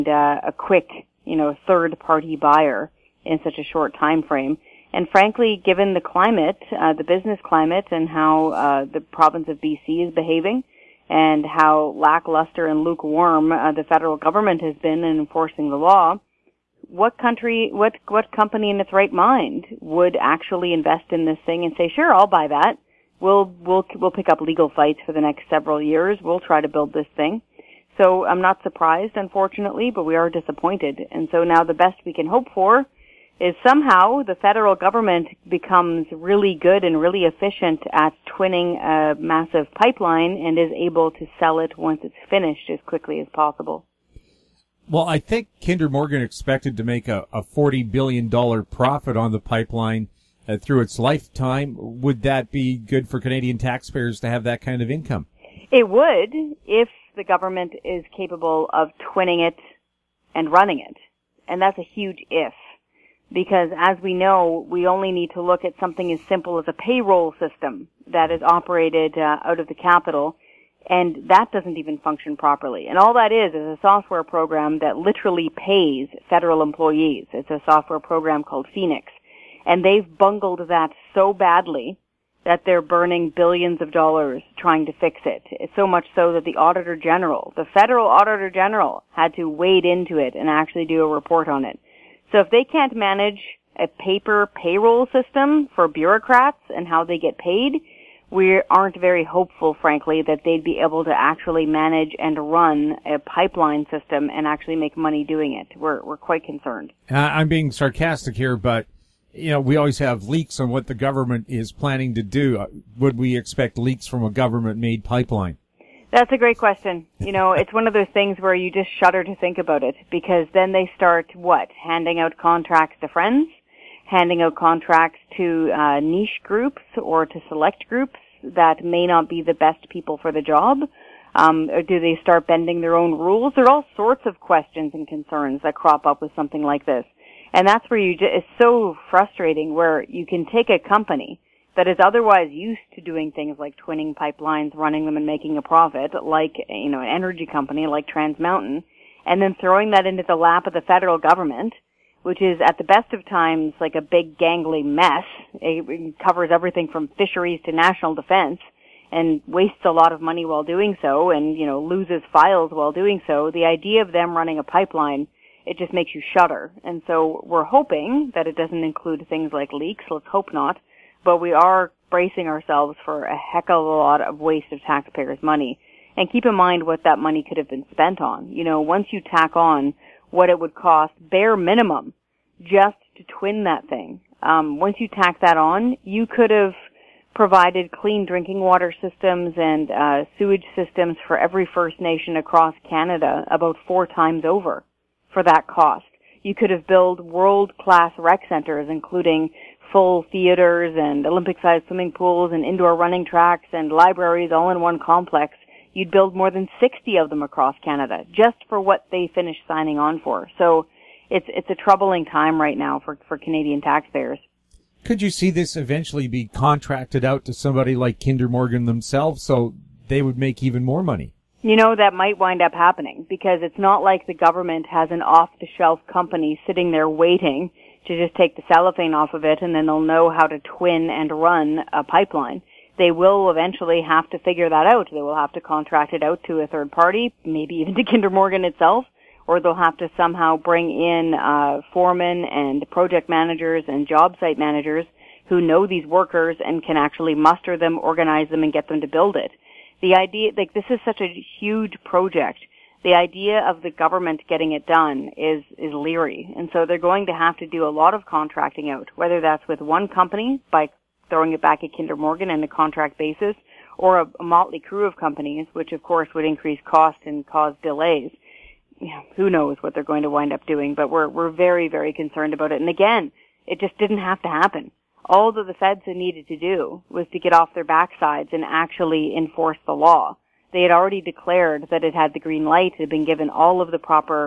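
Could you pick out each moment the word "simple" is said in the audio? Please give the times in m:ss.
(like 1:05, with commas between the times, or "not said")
1:06.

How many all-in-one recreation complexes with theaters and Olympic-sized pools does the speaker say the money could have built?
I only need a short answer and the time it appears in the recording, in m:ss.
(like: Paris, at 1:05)
More than 60, at 3:26.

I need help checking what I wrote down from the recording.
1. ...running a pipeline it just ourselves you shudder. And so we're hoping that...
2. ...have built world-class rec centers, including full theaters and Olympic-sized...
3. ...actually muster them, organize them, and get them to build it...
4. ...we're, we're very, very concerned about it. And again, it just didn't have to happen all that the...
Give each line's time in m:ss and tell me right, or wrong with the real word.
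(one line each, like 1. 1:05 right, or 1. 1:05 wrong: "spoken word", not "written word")
1. 2:44 wrong: "makes", not "ourselves"
2. 3:16 right
3. 4:06 right
4. 4:31 right.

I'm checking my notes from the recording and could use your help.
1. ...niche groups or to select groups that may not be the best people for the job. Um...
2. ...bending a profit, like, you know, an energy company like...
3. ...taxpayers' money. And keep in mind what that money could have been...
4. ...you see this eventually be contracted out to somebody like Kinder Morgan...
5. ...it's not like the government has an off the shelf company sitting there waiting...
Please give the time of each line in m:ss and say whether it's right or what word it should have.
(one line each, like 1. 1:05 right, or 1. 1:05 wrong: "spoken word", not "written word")
1. 2:05 right
2. 2:25 wrong: "making", not "bending"
3. 2:54 right
4. 3:35 right
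5. 3:43 right.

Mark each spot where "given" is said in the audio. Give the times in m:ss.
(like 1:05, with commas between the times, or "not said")
0:05, 4:43.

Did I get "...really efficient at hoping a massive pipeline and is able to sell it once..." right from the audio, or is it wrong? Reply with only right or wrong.
wrong.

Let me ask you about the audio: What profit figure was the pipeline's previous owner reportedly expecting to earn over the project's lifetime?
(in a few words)
$40 billion.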